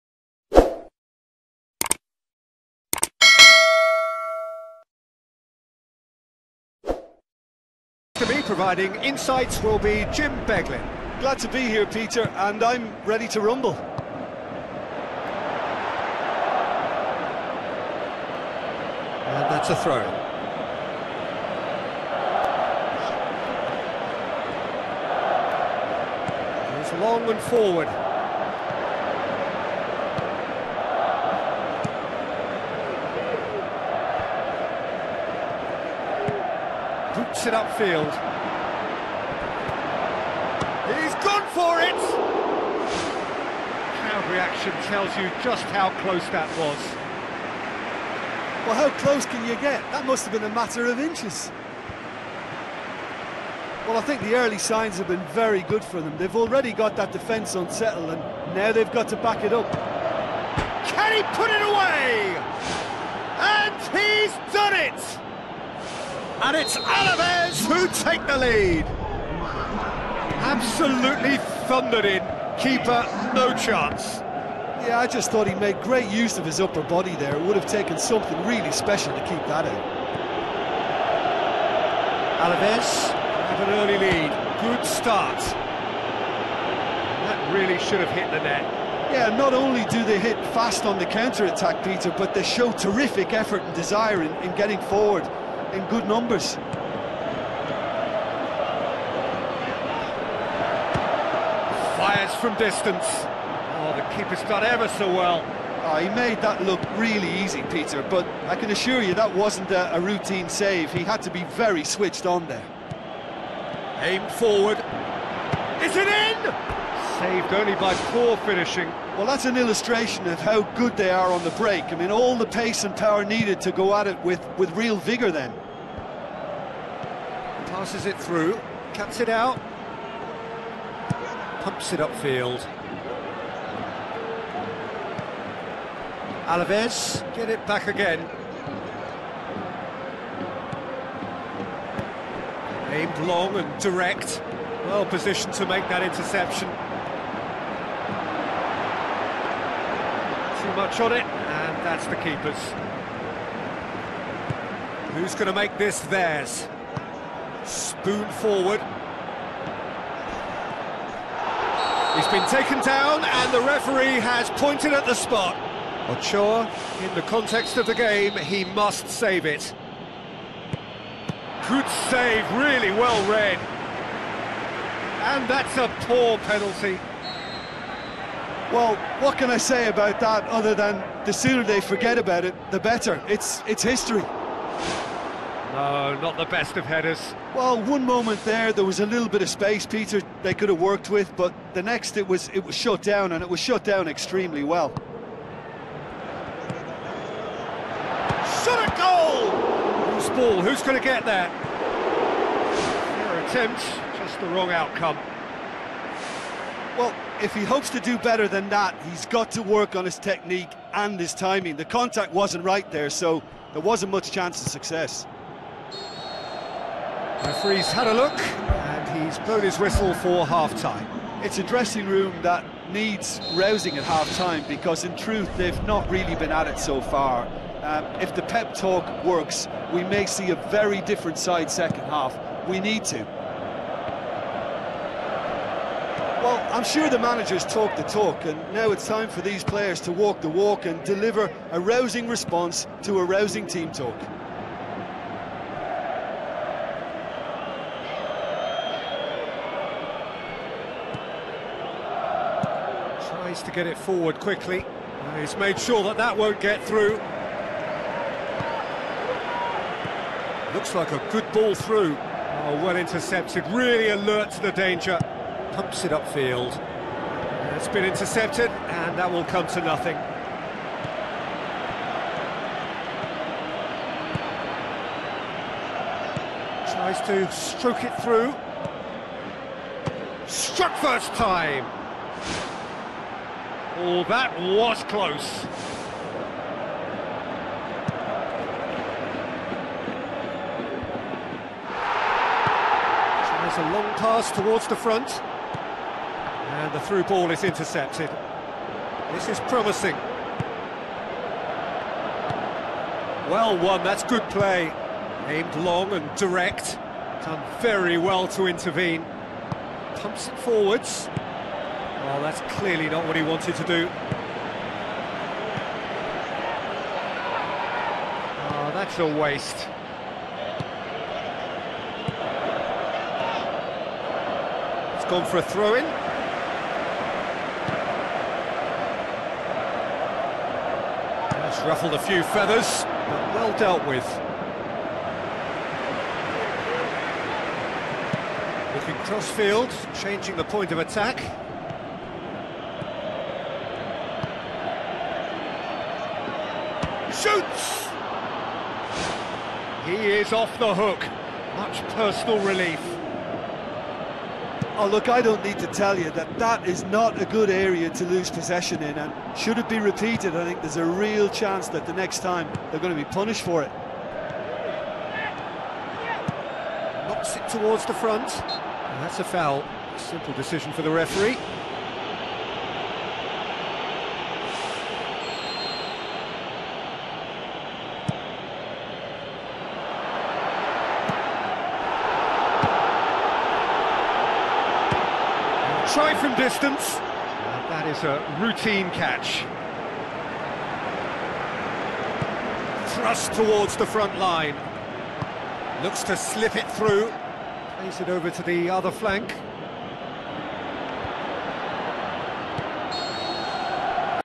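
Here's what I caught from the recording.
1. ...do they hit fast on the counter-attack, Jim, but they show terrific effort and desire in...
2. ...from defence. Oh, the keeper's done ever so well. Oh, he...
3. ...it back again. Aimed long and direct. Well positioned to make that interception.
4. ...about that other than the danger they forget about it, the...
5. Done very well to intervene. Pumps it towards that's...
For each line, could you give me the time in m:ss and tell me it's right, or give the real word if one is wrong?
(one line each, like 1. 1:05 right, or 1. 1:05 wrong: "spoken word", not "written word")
1. 1:29 wrong: "Peter", not "Jim"
2. 1:42 wrong: "distance", not "defence"
3. 2:17 right
4. 2:59 wrong: "sooner", not "danger"
5. 5:07 wrong: "forwards", not "towards".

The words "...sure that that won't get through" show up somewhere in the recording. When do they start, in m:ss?
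4:15.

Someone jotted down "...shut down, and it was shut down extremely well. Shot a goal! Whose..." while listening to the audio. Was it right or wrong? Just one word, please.
right.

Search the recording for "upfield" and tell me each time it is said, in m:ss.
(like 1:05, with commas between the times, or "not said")
0:37, 2:12, 4:26.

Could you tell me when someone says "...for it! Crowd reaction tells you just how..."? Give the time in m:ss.
0:41.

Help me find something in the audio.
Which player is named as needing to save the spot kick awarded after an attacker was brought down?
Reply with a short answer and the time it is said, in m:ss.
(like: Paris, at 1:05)
Ochoa, at 2:46.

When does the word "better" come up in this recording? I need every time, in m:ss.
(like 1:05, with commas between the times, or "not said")
3:02, 3:28.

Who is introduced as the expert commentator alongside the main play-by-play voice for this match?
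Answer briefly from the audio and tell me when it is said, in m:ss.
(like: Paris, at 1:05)
Jim Beglin, at 0:10.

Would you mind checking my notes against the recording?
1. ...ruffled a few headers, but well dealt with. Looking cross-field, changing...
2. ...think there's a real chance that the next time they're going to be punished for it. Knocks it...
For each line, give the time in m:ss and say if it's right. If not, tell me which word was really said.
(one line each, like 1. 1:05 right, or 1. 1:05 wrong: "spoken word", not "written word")
1. 5:31 wrong: "feathers", not "headers"
2. 6:00 right.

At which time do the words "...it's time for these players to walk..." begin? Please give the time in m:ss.
3:58.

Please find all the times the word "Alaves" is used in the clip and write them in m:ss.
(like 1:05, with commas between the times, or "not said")
1:06, 1:22, 2:16.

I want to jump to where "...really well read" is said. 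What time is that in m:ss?
2:52.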